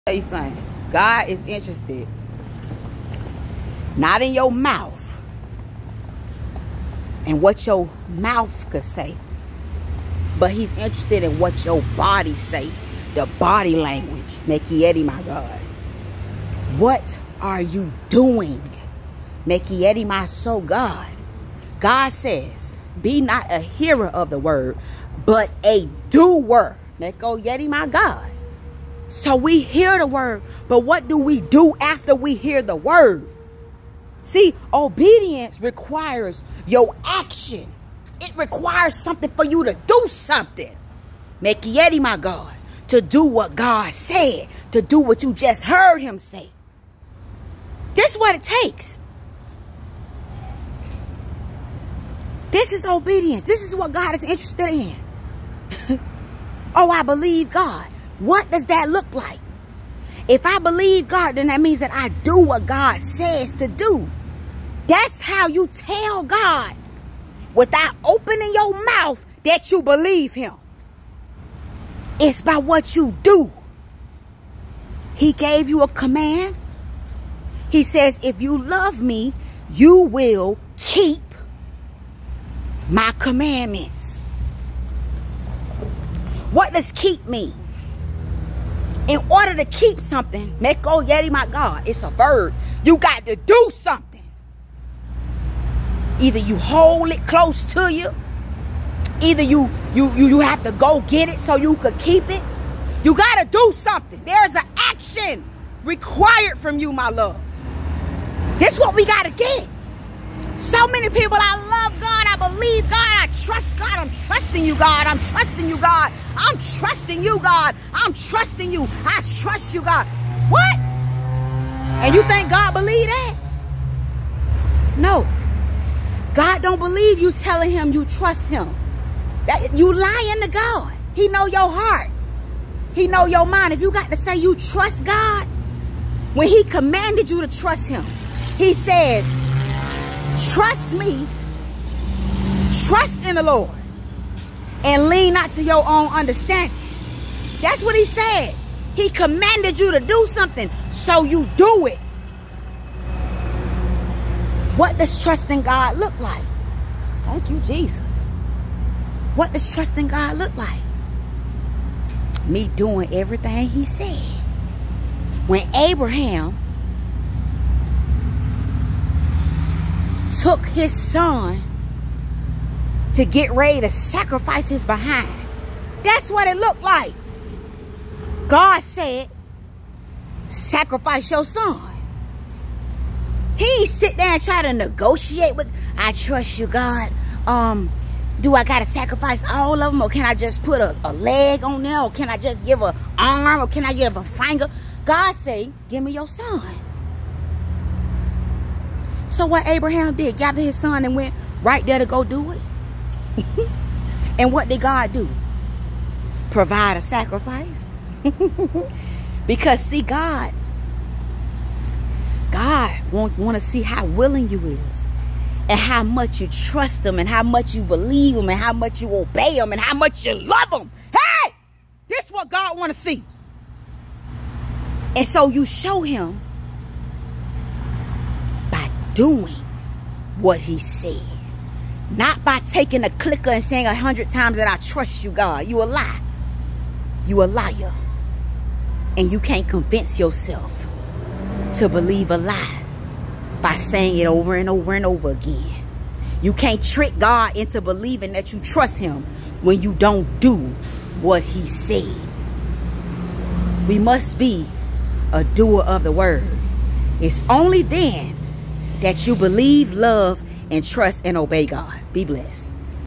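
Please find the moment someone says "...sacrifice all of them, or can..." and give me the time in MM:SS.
03:08.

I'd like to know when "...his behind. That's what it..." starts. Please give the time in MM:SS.
02:54.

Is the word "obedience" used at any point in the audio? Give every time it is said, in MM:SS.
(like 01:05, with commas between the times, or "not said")
00:34, 00:52.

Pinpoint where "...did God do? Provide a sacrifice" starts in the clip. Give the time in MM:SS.
03:24.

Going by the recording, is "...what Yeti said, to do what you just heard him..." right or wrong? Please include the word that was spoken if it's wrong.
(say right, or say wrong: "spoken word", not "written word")
wrong: "God", not "Yeti".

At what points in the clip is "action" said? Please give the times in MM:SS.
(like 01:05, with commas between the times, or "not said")
00:37, 01:44.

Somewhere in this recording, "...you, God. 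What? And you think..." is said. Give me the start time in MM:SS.
01:59.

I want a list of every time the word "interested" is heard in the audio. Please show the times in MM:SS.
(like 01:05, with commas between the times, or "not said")
00:01, 00:10, 00:54.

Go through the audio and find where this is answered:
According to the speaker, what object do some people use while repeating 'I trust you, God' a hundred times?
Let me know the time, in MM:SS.
03:53.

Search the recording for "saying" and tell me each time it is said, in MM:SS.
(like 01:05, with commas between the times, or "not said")
03:53, 04:03.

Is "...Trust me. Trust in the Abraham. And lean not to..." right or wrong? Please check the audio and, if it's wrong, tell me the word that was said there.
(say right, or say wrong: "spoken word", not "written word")
wrong: "Lord", not "Abraham".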